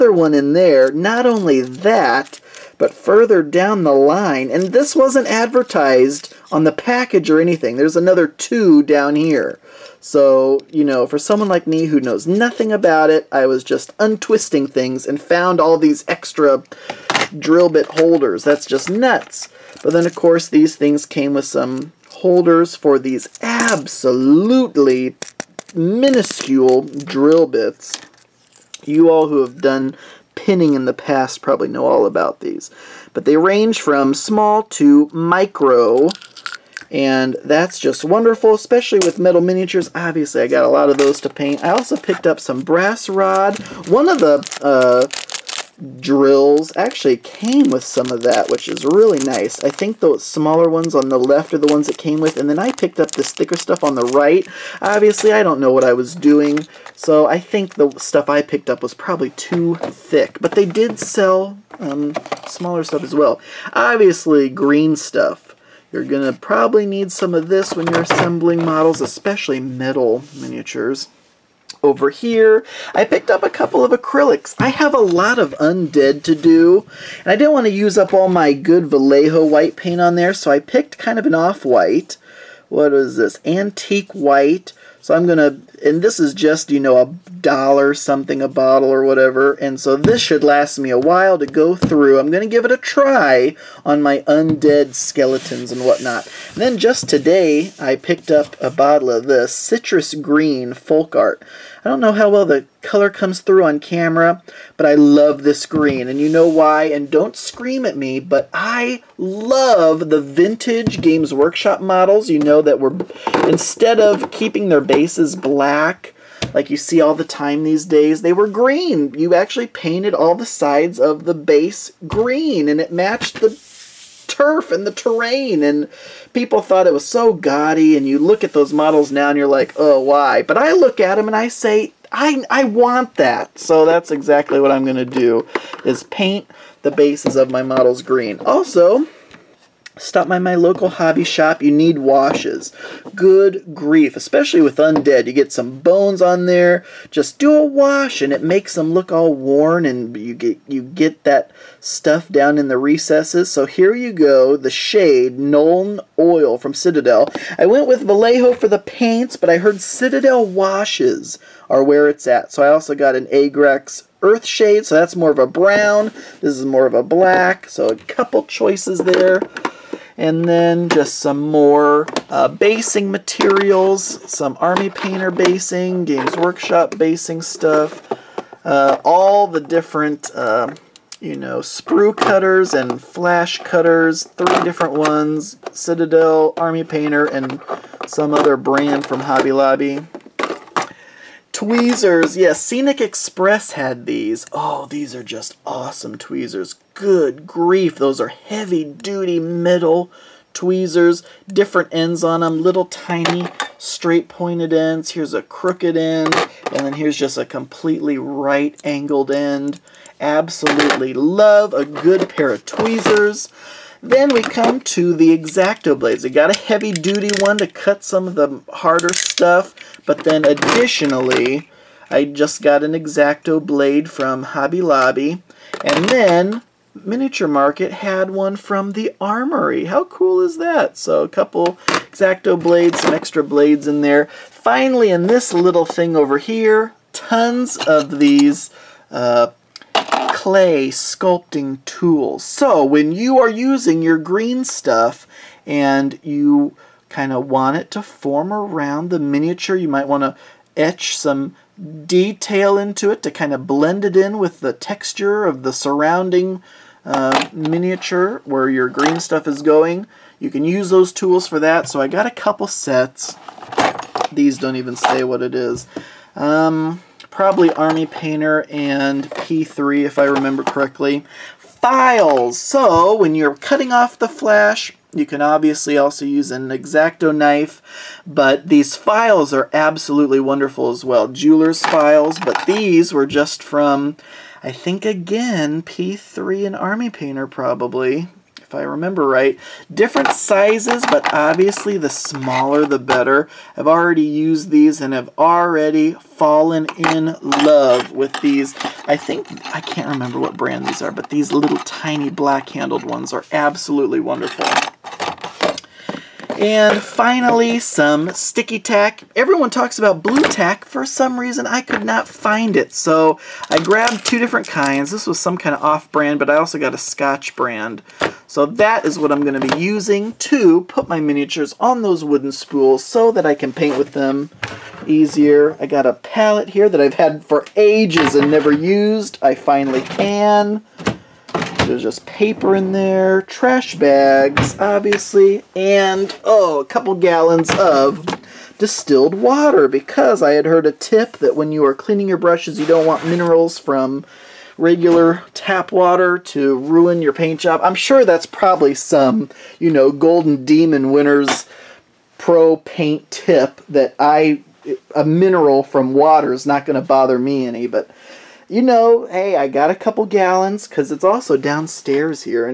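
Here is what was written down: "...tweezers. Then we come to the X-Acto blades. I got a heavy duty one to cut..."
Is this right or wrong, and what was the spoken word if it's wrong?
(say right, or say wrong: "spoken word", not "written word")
right.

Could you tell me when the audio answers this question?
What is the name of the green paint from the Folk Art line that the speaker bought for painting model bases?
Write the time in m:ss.
1:39.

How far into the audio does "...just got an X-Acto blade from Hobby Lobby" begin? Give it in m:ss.
3:42.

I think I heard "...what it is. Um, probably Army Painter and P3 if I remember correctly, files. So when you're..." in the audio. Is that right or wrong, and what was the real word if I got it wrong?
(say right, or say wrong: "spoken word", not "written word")
right.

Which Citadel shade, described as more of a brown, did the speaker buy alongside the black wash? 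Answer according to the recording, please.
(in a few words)
Agrex earth shade.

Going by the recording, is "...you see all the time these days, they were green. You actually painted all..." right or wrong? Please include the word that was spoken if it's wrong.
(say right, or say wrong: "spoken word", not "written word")
right.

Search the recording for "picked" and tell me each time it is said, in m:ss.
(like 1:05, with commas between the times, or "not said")
0:41, 0:52, 0:58, 1:13, 1:20, 1:37.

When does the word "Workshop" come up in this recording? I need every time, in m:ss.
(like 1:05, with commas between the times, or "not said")
1:51, 2:56.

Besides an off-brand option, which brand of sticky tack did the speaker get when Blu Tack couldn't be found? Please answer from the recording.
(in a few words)
Scotch.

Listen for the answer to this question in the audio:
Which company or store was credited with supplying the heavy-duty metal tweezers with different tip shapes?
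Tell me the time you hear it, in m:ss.
3:12.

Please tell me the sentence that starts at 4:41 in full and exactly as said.
Jeweler's files, but these were just from, I think again, P3 and Army Painter probably if I remember right.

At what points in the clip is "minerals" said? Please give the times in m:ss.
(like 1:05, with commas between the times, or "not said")
5:43, 5:55.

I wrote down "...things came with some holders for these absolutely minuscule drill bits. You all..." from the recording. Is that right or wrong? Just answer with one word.
right.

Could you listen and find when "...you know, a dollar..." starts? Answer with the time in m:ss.
1:26.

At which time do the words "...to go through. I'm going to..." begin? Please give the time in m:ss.
1:31.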